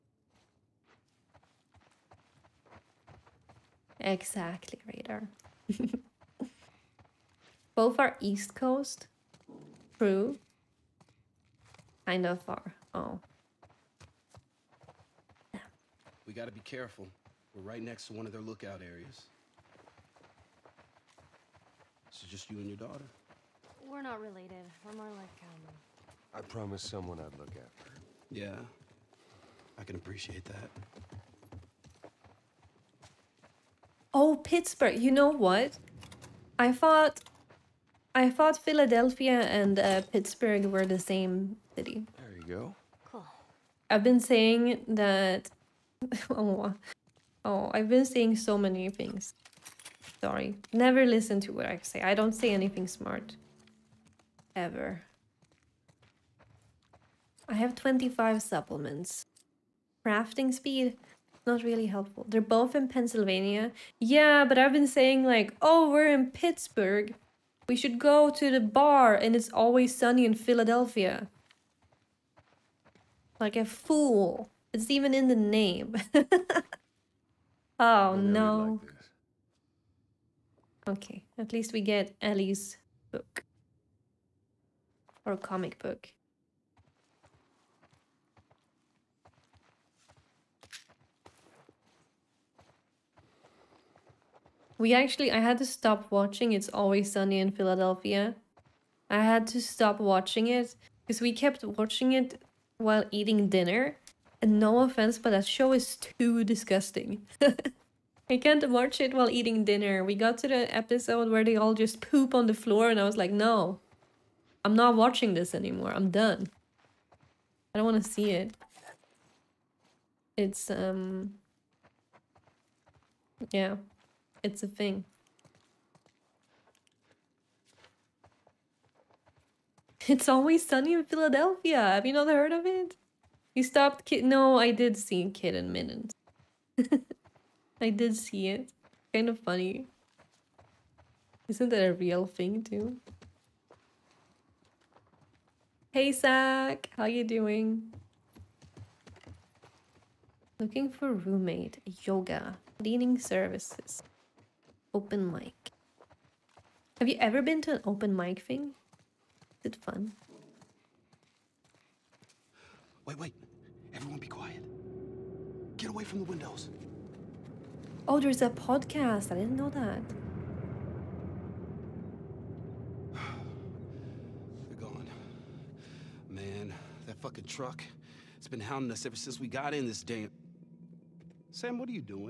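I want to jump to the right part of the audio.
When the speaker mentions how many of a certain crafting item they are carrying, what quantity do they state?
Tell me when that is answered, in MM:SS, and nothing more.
00:57.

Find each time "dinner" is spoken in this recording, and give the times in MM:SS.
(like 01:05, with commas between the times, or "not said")
01:43, 01:49.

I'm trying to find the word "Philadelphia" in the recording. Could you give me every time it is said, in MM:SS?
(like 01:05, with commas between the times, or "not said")
00:38, 01:10, 01:37, 02:11.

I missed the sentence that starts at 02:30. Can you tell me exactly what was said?
Looking for roommate, yoga, cleaning services, open mic.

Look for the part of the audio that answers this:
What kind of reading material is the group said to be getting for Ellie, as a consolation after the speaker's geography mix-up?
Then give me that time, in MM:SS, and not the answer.
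01:25.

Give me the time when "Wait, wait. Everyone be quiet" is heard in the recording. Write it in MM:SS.
02:43.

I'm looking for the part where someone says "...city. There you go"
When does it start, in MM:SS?
00:41.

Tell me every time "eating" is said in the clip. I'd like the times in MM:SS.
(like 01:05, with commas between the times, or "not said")
01:43, 01:49.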